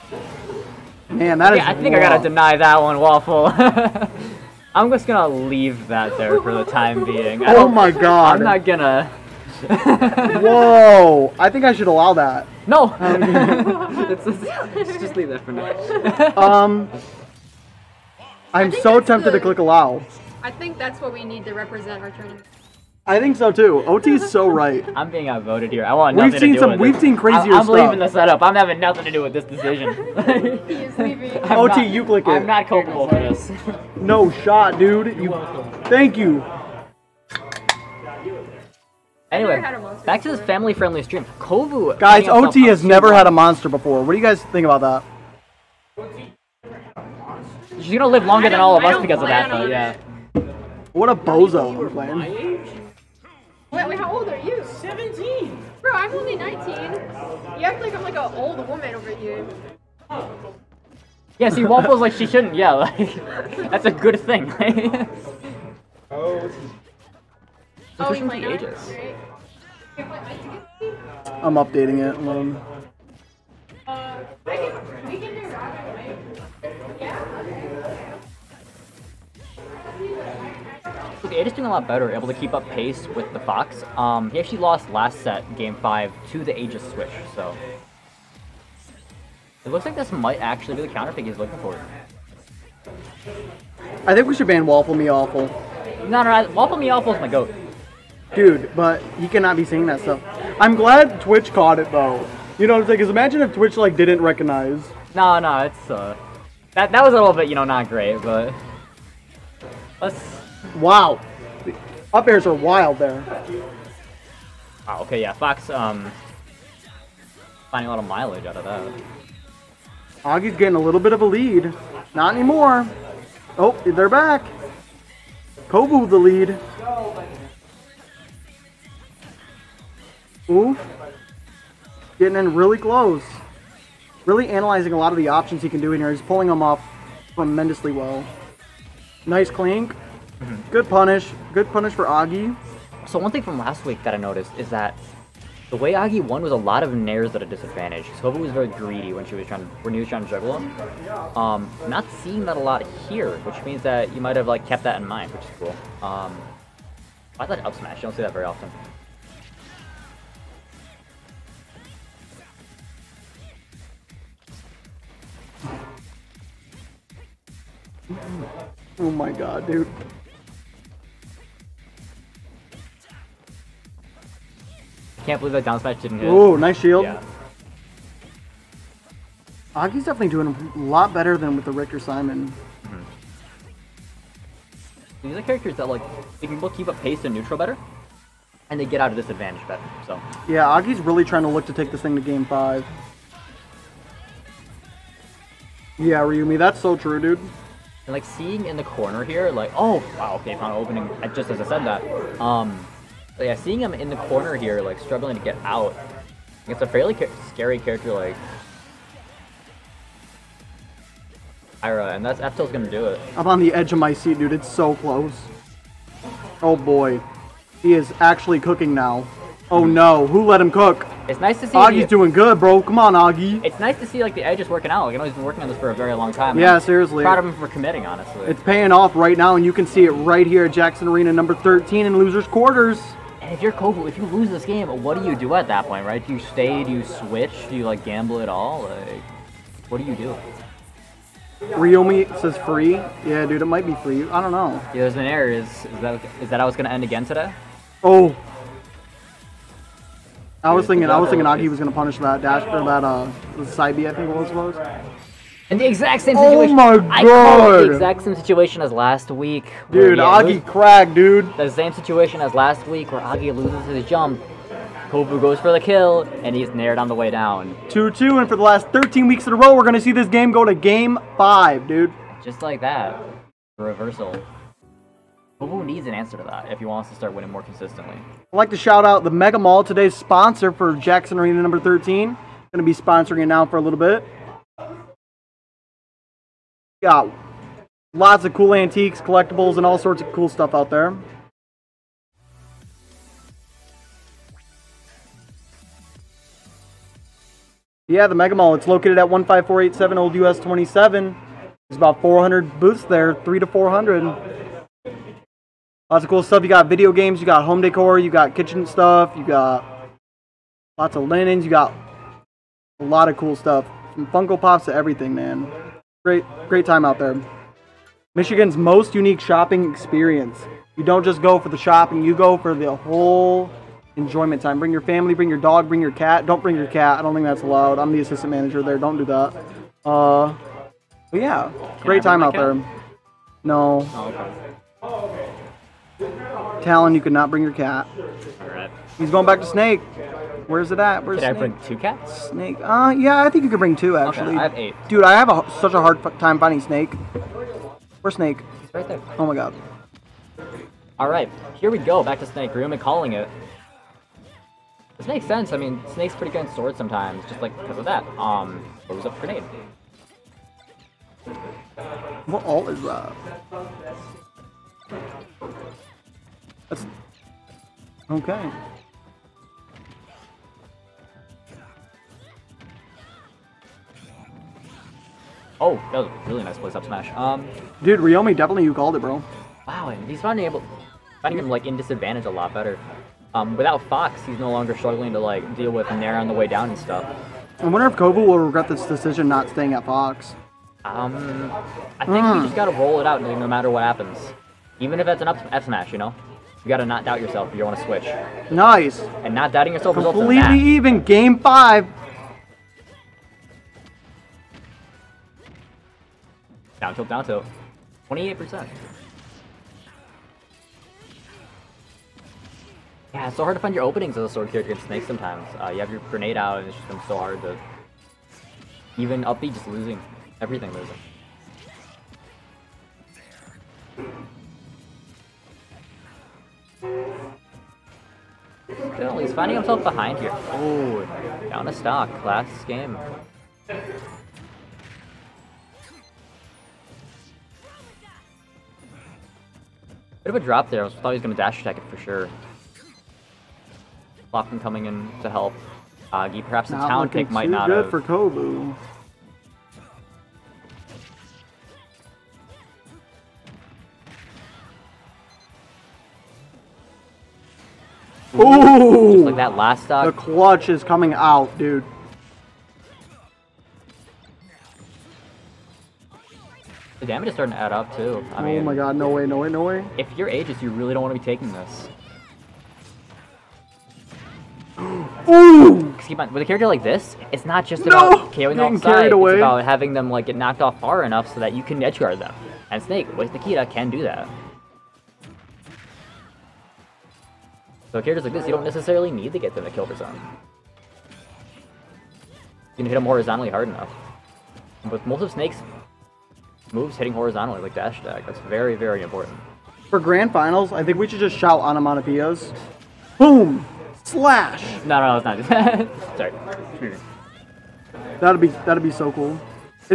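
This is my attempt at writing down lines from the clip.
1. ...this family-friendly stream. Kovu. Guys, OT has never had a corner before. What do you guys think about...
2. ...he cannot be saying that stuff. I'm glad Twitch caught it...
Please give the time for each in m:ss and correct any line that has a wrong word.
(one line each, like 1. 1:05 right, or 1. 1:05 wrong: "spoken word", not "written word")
1. 0:40 wrong: "monster", not "corner"
2. 1:39 right.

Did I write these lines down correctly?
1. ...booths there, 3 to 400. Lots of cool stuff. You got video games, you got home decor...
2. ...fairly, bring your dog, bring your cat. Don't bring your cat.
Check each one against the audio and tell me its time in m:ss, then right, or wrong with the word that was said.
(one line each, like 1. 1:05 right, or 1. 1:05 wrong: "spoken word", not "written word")
1. 5:02 right
2. 5:25 wrong: "family", not "fairly".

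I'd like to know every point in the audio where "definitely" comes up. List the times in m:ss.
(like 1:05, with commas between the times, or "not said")
3:00, 6:18.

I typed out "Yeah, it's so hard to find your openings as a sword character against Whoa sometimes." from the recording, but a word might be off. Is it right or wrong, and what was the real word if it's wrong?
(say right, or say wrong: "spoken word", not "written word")
wrong: "Snake", not "Whoa".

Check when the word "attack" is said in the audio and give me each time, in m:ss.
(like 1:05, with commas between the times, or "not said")
7:21, 8:18.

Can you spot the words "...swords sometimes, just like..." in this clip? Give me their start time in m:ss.
5:56.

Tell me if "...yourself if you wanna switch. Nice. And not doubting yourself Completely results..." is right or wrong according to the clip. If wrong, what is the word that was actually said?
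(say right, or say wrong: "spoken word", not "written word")
right.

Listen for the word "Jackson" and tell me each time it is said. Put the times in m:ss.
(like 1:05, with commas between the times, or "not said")
3:50, 4:40.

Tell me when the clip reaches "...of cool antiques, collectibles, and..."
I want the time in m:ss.
4:48.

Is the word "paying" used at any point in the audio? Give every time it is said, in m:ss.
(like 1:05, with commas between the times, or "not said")
3:48.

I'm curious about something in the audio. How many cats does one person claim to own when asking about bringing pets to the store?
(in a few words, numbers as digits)
8.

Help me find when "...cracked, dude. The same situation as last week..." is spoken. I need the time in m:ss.
4:20.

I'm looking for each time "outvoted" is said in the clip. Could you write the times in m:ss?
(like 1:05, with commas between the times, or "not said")
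0:25.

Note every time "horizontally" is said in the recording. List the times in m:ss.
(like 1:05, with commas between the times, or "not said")
8:13, 8:17.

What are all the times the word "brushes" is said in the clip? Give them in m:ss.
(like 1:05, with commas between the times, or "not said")
not said.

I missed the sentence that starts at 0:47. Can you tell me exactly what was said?
She's gonna live longer than all of us because of that, though, yeah.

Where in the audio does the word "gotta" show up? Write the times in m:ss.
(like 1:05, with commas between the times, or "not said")
0:02, 6:32, 6:36.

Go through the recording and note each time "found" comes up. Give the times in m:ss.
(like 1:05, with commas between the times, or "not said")
3:20.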